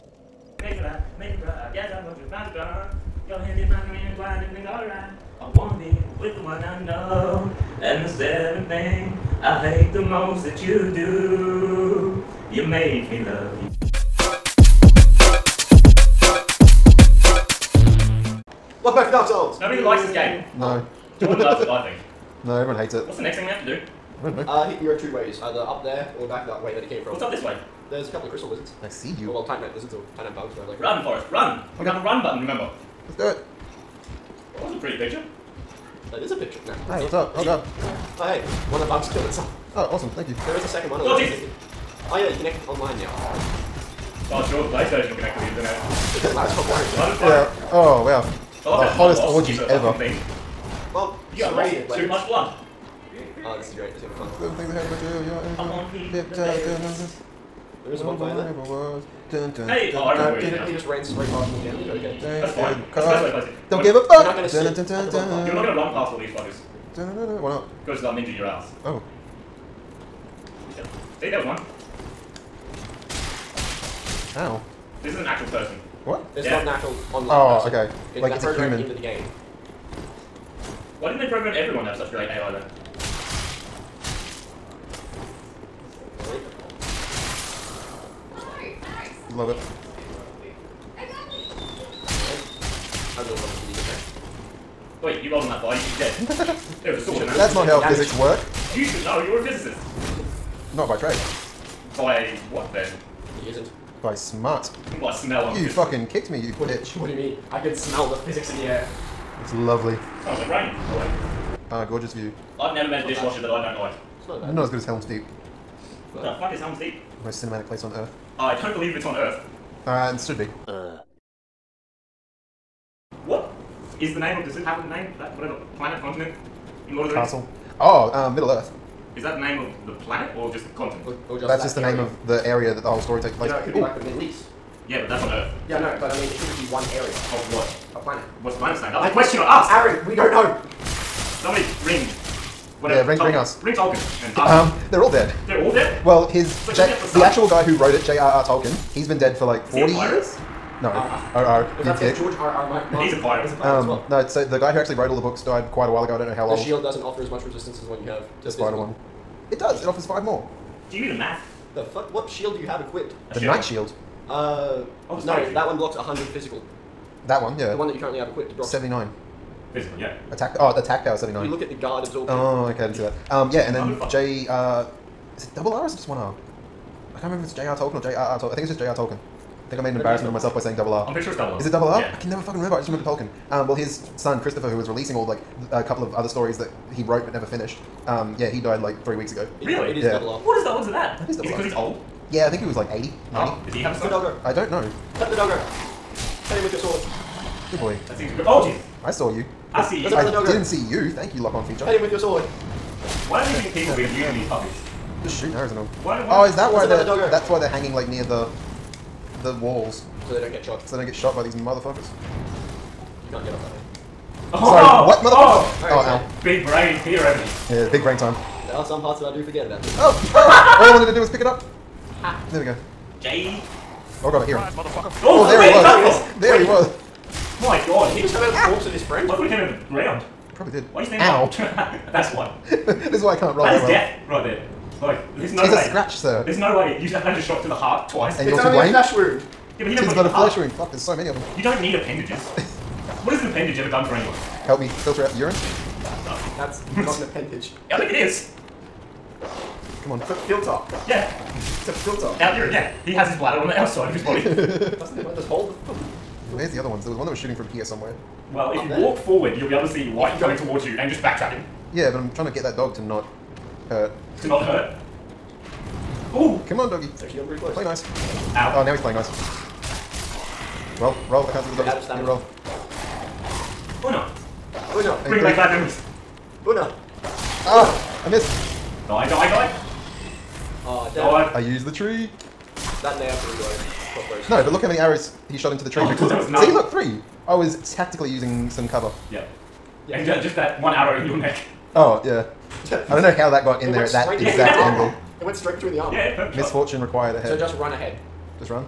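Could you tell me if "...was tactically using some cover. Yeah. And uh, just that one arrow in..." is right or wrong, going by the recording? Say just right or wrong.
right.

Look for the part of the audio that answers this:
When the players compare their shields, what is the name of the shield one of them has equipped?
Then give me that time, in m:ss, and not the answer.
2:43.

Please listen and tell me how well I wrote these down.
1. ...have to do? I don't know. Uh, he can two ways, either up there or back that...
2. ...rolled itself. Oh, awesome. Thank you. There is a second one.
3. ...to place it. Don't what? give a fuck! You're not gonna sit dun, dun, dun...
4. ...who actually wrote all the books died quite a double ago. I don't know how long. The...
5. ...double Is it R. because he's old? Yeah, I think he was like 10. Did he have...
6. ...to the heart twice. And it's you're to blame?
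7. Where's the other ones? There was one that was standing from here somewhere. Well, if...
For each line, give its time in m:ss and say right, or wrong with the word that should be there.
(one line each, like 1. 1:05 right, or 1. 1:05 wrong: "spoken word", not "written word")
1. 0:23 right
2. 0:39 wrong: "killed", not "rolled"
3. 1:03 right
4. 2:34 wrong: "while", not "double"
5. 3:11 wrong: "80", not "10"
6. 3:57 right
7. 4:16 wrong: "shooting", not "standing".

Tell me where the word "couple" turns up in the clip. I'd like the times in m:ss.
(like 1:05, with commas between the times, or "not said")
0:28, 3:05.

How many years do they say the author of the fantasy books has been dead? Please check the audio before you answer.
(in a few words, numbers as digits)
40.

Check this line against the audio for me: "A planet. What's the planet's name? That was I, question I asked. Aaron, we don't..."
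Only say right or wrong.
right.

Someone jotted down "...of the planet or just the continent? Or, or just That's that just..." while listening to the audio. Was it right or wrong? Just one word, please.
right.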